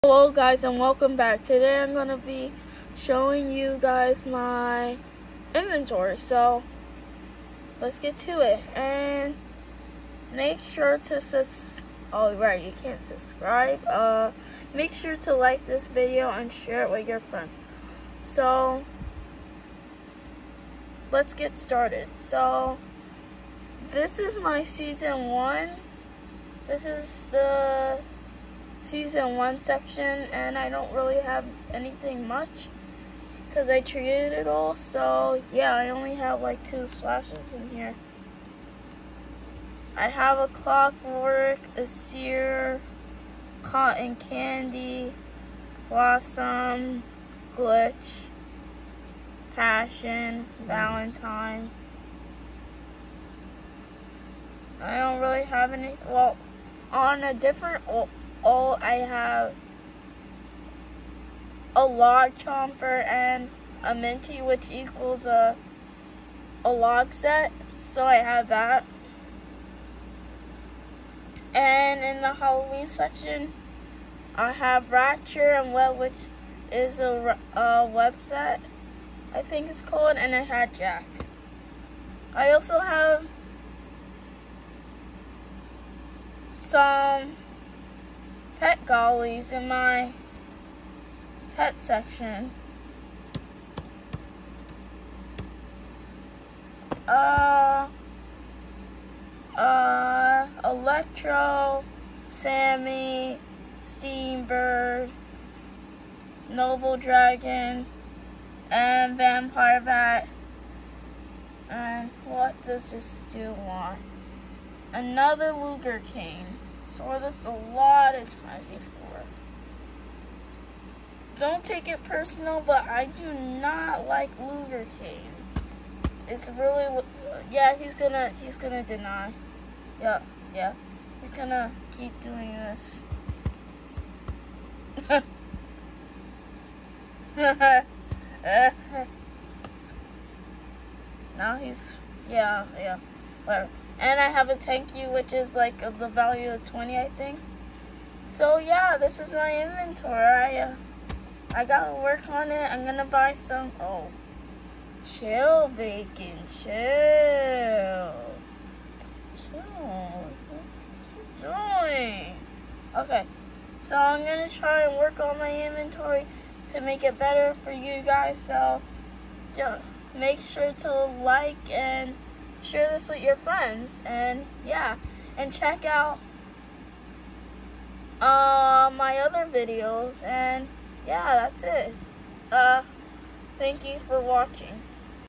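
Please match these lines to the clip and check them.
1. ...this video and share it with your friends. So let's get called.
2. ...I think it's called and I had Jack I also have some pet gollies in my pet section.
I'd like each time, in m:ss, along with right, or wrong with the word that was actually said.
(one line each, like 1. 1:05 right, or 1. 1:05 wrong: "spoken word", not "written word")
1. 0:15 wrong: "started", not "called"
2. 1:19 right.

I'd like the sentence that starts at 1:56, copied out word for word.
Saw this a lot of times before.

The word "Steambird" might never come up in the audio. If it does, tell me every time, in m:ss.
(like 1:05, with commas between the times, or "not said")
1:43.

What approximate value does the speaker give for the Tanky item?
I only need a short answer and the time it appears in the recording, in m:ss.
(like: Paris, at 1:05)
20, at 2:26.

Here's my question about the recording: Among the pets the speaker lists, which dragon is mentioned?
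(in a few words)
Noble Dragon.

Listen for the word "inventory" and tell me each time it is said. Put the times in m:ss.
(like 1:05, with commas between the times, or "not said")
0:05, 2:29, 2:45.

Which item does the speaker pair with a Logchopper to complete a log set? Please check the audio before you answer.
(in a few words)
Minty.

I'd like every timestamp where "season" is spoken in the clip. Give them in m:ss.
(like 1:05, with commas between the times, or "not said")
0:24, 0:28.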